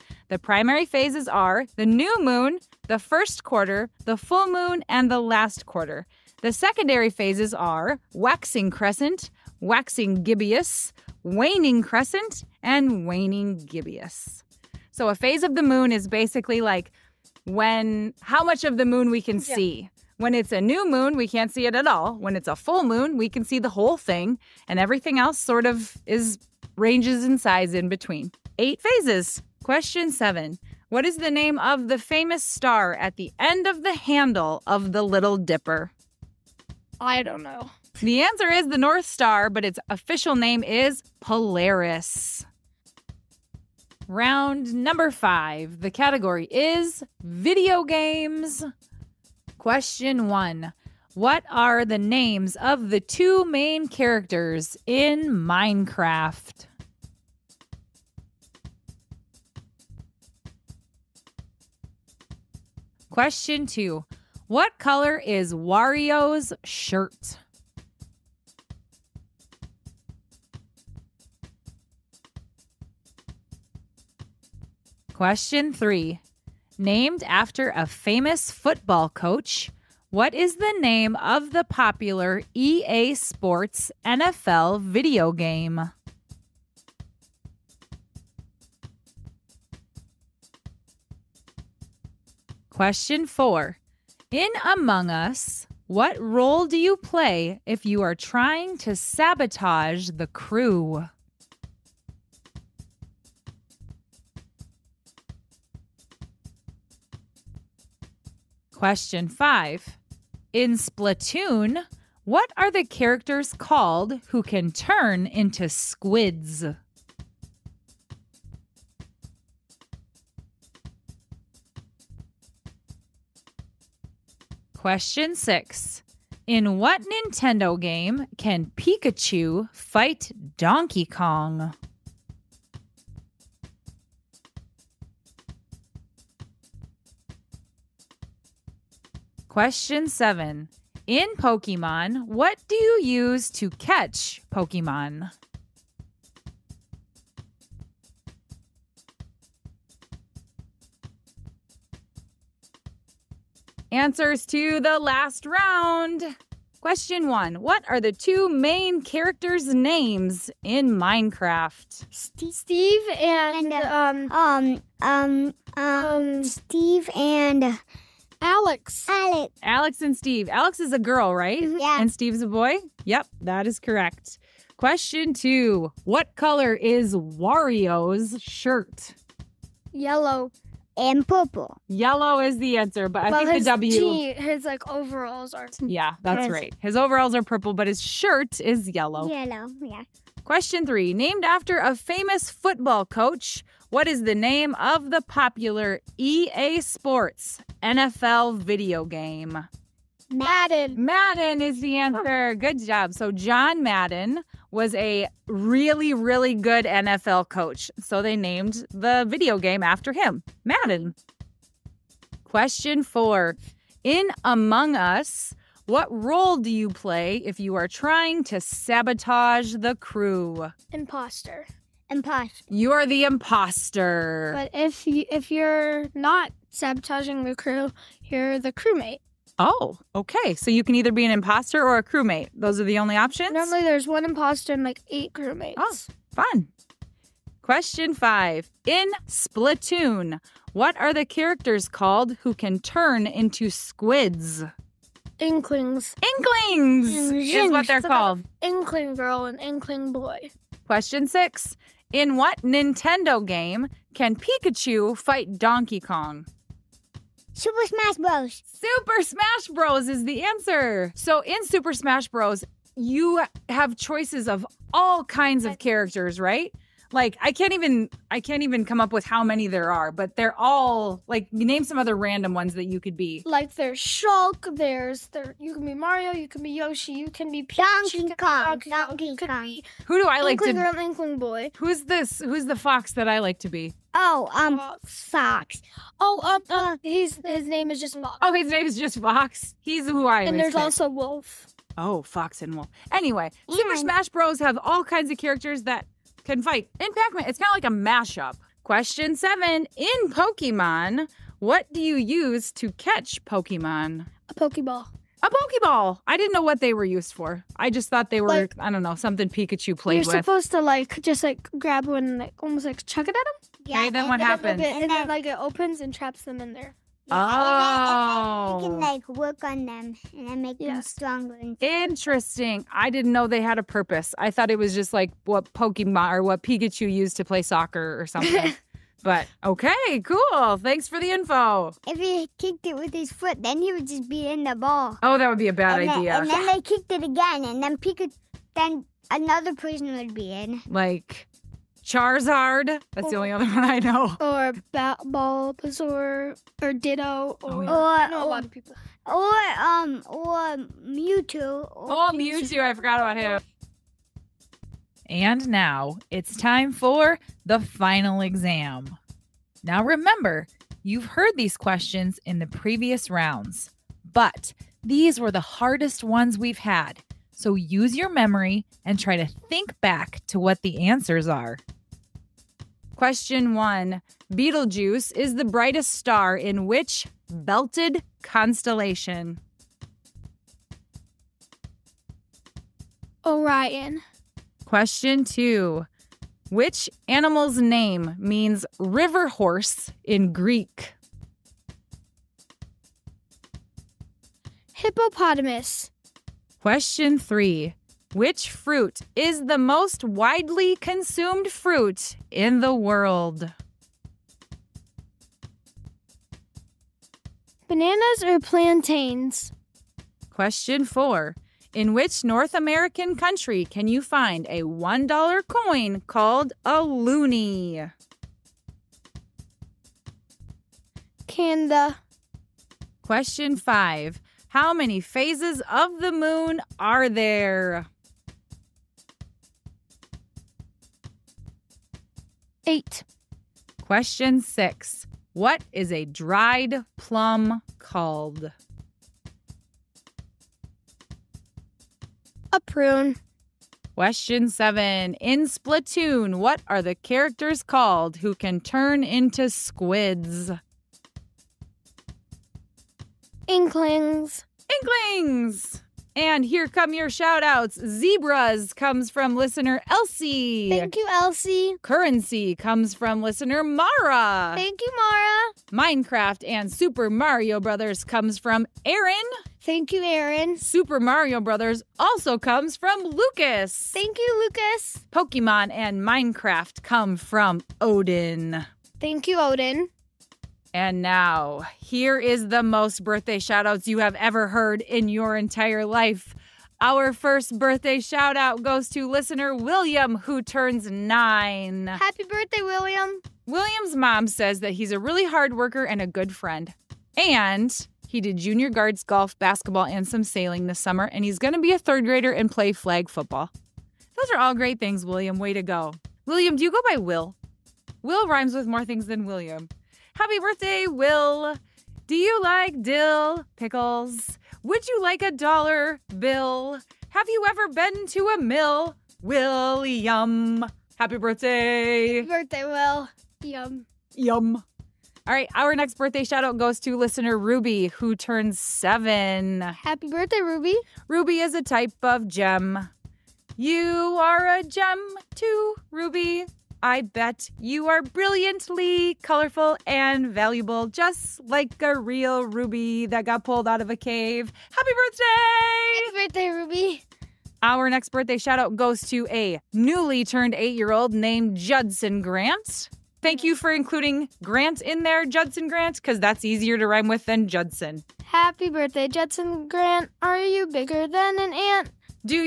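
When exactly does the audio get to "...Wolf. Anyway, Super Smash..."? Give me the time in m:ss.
4:52.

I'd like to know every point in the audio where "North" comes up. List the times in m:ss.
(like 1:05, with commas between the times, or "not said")
0:38, 6:52.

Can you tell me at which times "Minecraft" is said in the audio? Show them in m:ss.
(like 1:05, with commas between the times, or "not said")
0:55, 2:40, 7:45, 7:56.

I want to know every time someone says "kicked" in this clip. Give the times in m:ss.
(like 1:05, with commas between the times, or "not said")
5:32, 5:36.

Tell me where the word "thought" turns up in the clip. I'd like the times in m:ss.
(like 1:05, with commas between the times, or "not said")
5:08, 5:24.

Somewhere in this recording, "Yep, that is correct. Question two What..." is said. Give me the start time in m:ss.
2:53.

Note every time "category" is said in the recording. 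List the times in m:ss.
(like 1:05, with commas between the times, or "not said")
0:45.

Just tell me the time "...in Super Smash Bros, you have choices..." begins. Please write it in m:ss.
4:21.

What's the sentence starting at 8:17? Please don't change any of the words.
And he did junior guards, golf, basketball, and some sailing this summer.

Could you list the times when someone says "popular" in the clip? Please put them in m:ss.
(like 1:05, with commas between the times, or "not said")
1:21, 3:15.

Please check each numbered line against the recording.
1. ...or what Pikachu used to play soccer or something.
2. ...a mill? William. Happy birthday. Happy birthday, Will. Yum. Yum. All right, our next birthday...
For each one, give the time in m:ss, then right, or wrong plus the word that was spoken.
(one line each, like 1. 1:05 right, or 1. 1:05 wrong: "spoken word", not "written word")
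1. 5:26 right
2. 8:38 right.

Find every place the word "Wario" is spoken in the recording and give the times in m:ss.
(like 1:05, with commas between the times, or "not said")
1:05, 2:57.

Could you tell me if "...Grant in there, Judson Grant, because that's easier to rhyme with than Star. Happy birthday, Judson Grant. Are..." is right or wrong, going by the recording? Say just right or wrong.
wrong.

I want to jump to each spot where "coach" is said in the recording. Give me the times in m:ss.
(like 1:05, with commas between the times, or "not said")
1:19, 3:13, 3:27.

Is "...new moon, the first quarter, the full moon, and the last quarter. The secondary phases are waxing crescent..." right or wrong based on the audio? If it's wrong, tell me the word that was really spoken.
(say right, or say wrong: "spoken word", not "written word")
right.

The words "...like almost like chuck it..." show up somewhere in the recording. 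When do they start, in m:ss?
5:12.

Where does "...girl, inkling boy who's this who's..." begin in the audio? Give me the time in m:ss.
4:40.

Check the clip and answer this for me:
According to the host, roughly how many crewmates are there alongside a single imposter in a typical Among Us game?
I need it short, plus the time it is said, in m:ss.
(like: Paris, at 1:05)
8, at 3:55.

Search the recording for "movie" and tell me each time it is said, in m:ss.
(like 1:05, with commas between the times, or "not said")
not said.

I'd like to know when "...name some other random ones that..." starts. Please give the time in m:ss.
4:31.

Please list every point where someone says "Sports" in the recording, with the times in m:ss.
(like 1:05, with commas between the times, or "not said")
1:23, 3:16.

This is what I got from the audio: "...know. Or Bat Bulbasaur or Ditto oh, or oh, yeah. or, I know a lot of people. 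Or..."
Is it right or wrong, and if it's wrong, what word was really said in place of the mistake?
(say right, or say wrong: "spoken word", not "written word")
right.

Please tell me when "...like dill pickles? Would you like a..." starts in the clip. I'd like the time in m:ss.
8:32.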